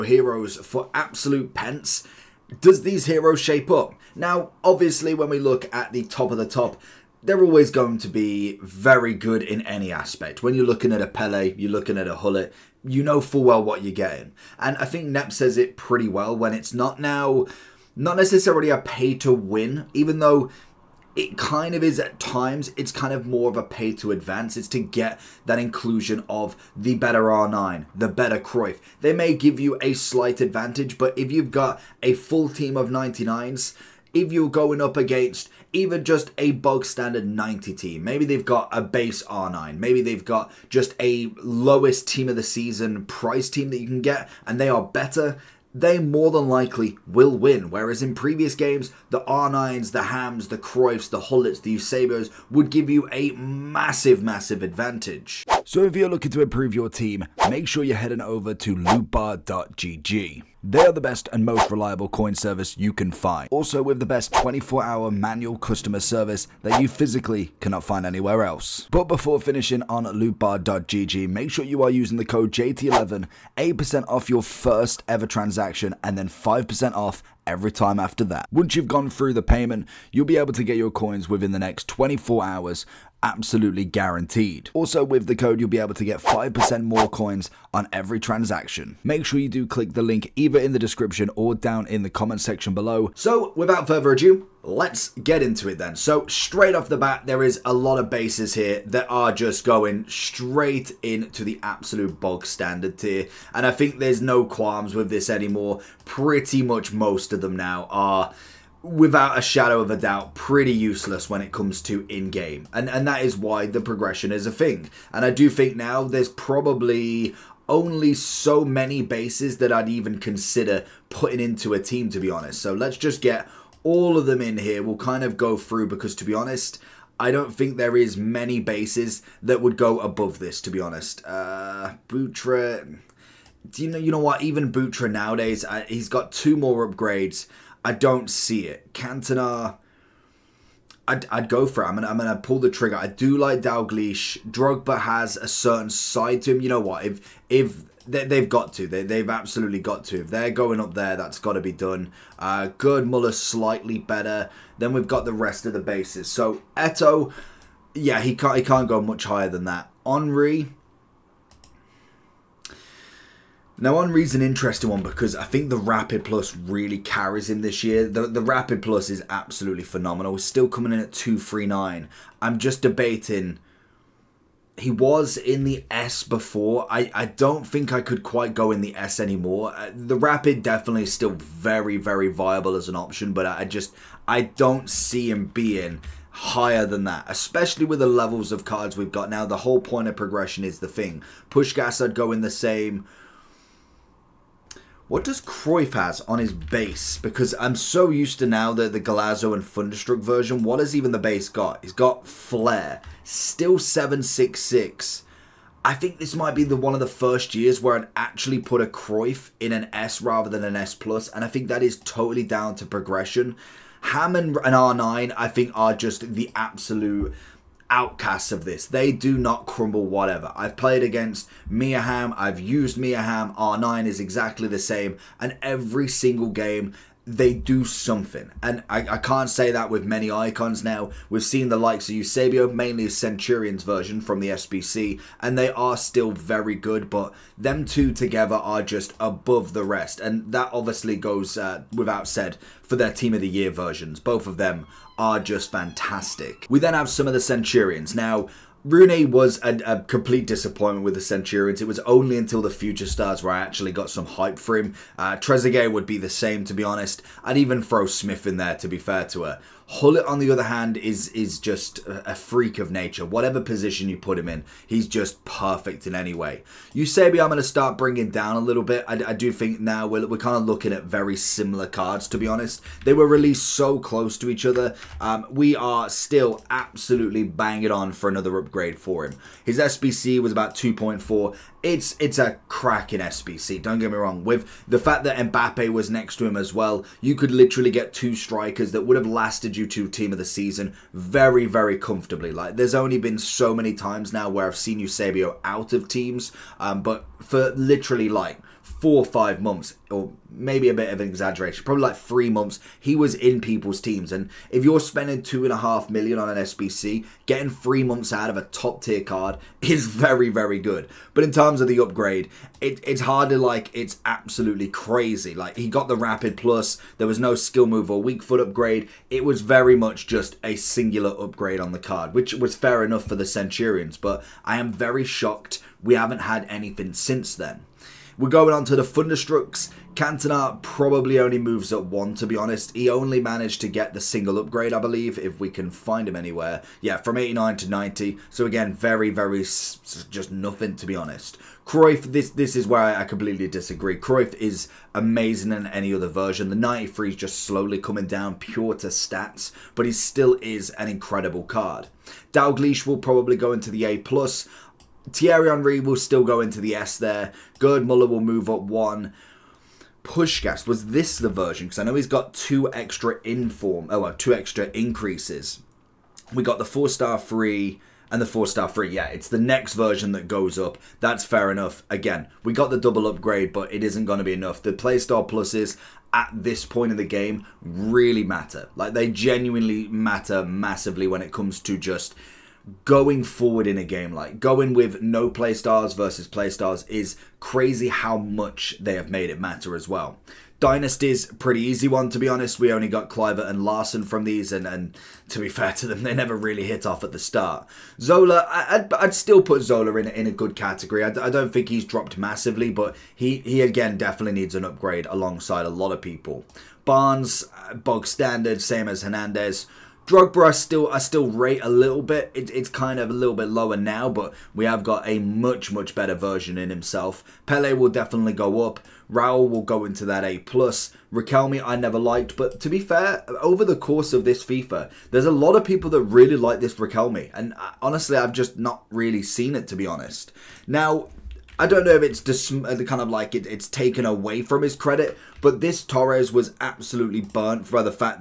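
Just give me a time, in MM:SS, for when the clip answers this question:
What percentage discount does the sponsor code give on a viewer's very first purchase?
01:13.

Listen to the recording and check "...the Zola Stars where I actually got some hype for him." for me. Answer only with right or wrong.
wrong.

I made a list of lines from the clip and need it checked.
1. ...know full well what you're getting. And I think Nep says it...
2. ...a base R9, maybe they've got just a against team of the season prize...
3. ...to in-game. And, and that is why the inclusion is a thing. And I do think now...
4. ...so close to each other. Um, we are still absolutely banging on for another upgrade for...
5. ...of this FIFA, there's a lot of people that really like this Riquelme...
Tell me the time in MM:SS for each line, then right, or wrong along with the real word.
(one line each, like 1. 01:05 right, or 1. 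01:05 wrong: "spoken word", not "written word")
1. 00:13 right
2. 00:38 wrong: "lowest", not "against"
3. 01:51 wrong: "progression", not "inclusion"
4. 04:33 right
5. 07:04 right.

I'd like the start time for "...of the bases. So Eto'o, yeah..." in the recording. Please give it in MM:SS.
02:35.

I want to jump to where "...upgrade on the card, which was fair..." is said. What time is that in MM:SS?
05:21.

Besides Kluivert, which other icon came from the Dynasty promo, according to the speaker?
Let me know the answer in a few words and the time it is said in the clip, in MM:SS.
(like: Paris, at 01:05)
Larsson, at 06:33.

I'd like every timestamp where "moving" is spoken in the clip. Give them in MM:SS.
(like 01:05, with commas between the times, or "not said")
not said.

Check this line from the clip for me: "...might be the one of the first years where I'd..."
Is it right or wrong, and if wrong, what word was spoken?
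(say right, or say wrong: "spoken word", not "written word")
right.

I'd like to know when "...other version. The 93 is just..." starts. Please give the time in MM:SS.
05:46.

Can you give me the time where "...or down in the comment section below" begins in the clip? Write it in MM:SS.
01:31.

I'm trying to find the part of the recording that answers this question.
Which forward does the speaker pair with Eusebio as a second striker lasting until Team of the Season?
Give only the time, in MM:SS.
04:45.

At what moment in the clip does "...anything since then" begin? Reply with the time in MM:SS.
05:26.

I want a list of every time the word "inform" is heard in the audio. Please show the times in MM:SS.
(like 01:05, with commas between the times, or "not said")
06:03.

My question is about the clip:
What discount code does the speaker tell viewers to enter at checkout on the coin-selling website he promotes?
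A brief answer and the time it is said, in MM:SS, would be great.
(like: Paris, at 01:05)
JT11, at 01:12.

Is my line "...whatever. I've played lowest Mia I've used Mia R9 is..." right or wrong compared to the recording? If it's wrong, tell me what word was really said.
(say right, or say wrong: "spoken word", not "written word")
wrong: "against", not "lowest".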